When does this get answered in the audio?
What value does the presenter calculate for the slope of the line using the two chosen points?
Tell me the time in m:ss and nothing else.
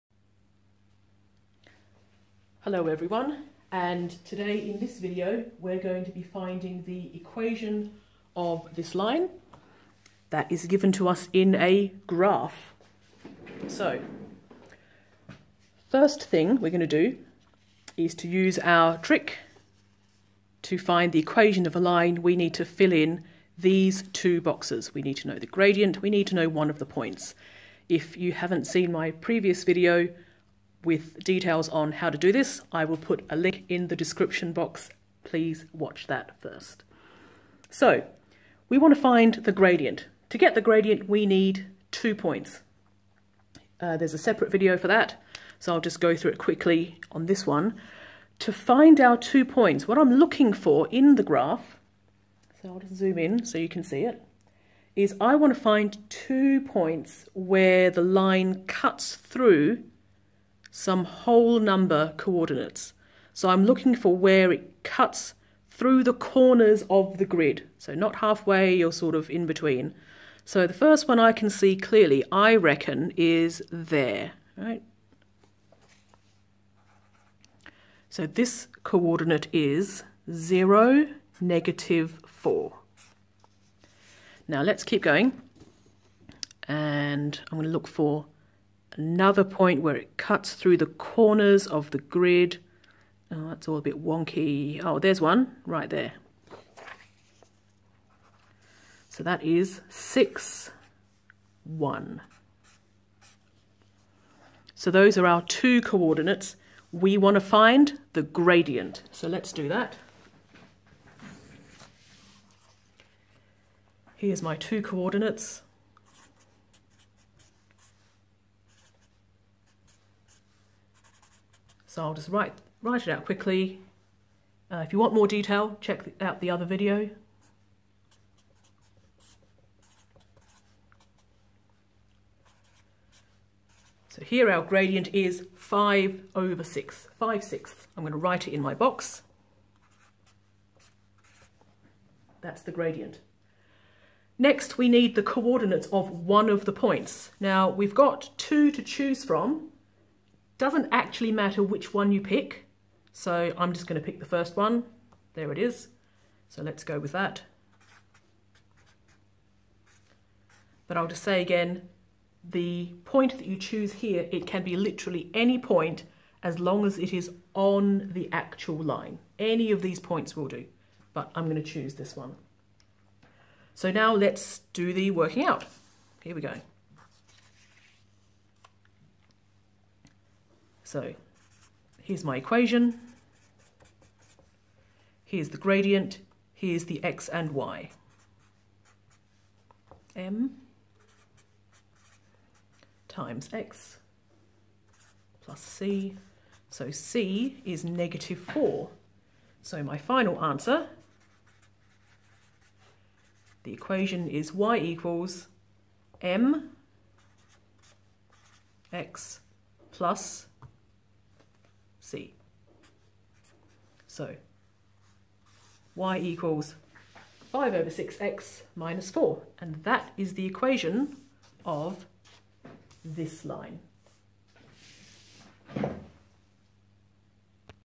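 2:15.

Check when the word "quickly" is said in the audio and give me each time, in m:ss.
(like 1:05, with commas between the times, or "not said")
0:46, 2:03.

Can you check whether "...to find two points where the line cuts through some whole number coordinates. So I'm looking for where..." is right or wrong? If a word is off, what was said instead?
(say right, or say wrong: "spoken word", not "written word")
right.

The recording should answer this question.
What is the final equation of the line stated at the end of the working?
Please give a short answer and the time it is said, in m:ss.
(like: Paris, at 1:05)
y = 5/6x - 4, at 3:35.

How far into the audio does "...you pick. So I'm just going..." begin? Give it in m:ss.
2:32.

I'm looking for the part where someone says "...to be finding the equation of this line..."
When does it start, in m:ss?
0:06.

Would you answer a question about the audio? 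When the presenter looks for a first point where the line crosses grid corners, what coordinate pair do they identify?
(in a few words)
0, -4.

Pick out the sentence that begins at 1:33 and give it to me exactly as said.
Oh, that's all a bit wonky.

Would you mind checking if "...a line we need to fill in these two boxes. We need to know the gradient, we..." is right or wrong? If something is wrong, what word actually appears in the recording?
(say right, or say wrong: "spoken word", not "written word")
right.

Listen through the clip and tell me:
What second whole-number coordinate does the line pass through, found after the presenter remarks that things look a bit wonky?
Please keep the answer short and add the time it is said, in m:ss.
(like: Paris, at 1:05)
6, 1, at 1:39.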